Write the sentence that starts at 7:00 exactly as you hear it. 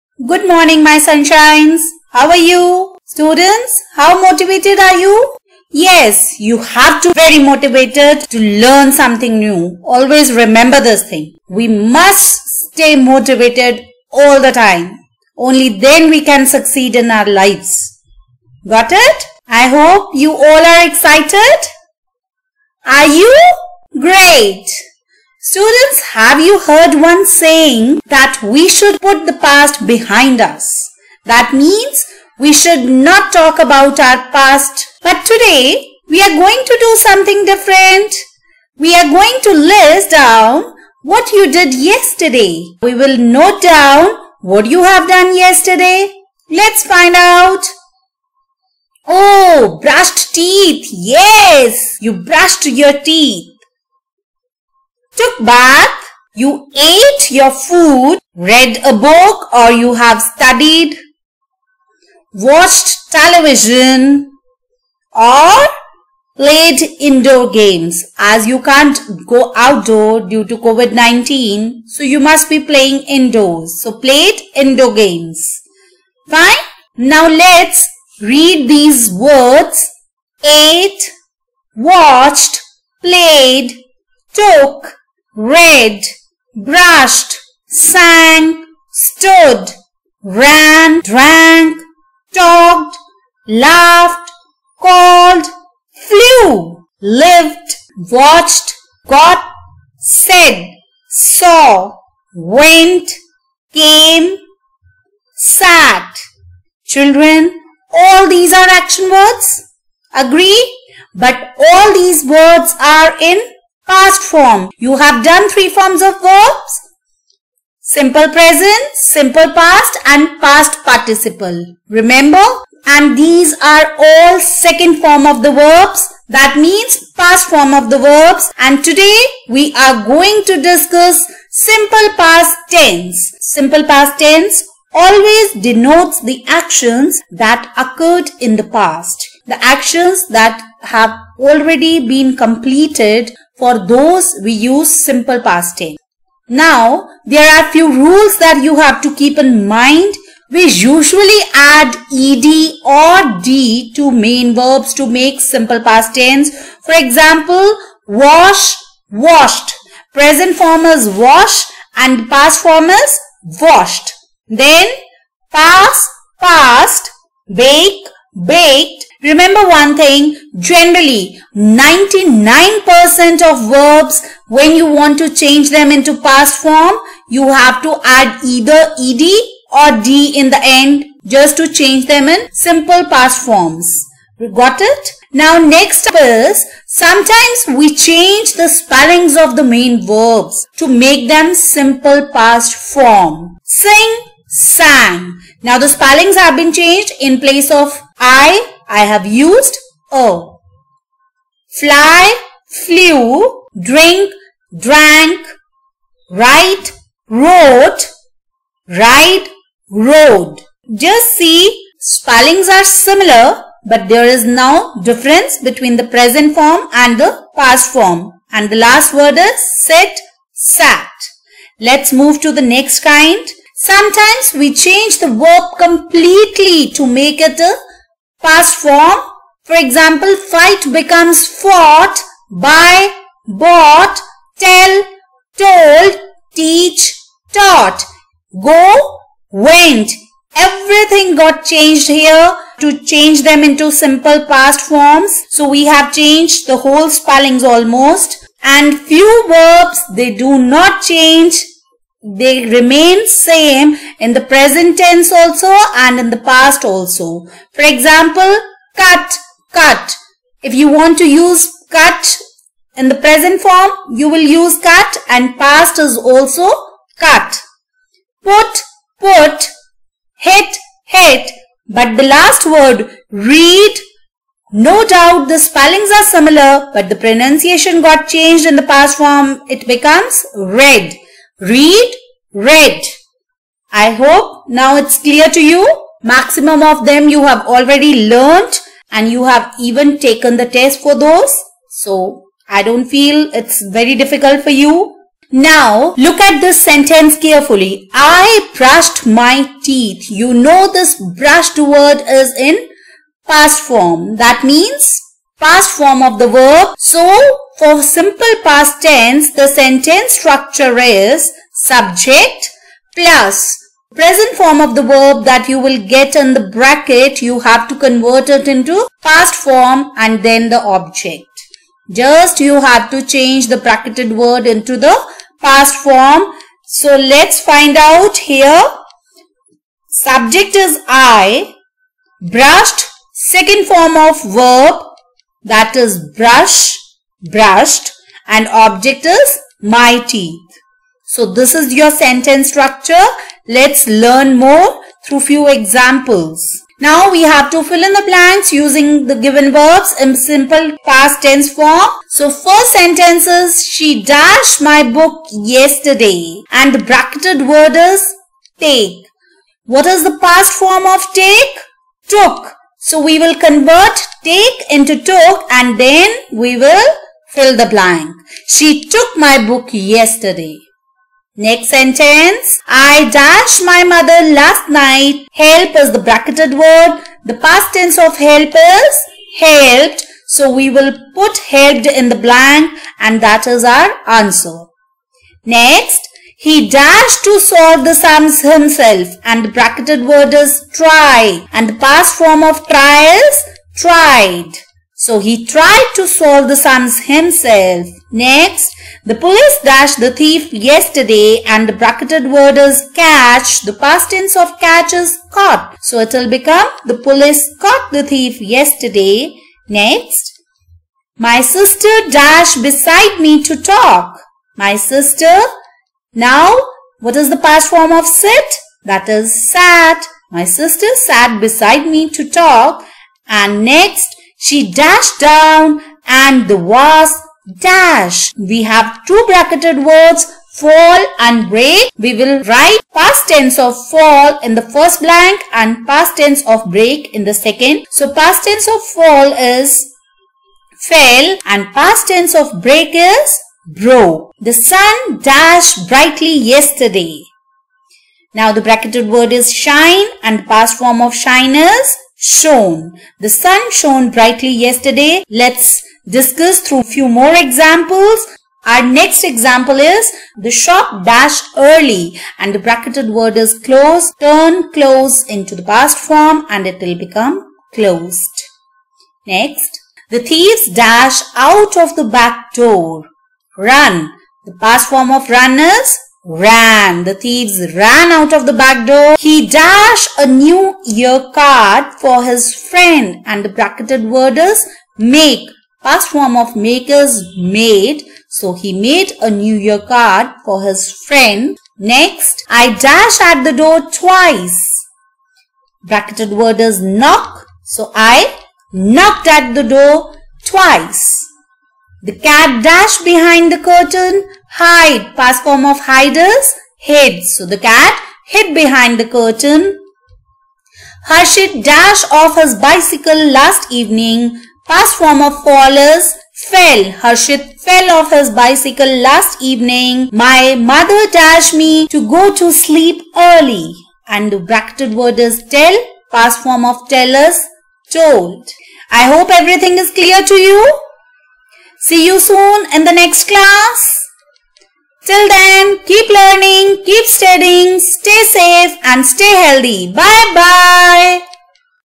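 My sister sat beside me to talk and next she dashed down and the was dash.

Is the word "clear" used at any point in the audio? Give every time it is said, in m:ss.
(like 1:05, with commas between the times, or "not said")
4:45, 8:50.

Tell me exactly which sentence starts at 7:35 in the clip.
Let's discuss through few more examples.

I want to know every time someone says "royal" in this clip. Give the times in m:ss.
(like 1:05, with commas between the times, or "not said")
not said.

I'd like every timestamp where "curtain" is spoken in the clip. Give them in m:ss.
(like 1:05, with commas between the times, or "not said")
8:23, 8:29.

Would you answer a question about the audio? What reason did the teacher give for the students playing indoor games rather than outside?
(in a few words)
COVID-19.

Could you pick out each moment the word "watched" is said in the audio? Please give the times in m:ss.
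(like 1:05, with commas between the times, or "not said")
1:02, 1:21, 1:38.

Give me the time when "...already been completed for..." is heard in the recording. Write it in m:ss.
2:21.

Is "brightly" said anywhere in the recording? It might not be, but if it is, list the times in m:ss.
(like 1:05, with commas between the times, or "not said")
7:26, 7:34.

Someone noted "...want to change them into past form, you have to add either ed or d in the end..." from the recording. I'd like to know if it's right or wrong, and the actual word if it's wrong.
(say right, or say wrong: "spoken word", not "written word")
right.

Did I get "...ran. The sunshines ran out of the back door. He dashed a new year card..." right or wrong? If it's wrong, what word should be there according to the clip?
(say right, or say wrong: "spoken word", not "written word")
wrong: "thieves", not "sunshines".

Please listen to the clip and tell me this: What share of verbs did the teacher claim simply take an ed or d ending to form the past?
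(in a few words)
99%.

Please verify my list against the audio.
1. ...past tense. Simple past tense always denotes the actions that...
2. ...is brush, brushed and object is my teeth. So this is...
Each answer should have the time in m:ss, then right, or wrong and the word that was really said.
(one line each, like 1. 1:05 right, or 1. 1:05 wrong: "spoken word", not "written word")
1. 2:12 right
2. 5:35 right.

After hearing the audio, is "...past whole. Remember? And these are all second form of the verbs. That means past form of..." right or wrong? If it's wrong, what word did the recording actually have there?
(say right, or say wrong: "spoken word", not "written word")
wrong: "participle", not "whole".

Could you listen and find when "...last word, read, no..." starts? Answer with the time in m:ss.
4:32.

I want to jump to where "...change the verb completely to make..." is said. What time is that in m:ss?
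3:44.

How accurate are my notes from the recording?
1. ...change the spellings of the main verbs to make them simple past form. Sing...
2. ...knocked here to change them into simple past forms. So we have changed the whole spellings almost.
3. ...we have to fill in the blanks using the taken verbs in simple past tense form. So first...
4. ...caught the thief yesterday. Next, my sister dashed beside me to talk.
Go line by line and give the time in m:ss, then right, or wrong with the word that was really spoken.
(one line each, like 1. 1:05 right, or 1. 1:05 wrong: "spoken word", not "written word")
1. 3:07 right
2. 4:01 wrong: "changed", not "knocked"
3. 5:47 wrong: "given", not "taken"
4. 6:47 right.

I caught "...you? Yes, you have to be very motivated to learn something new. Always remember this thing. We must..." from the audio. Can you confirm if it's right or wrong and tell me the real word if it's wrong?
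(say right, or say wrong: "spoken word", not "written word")
right.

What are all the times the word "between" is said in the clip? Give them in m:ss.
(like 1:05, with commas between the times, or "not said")
3:35.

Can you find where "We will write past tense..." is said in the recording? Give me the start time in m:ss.
7:12.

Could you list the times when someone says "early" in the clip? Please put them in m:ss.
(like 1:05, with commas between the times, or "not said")
7:41, 8:43.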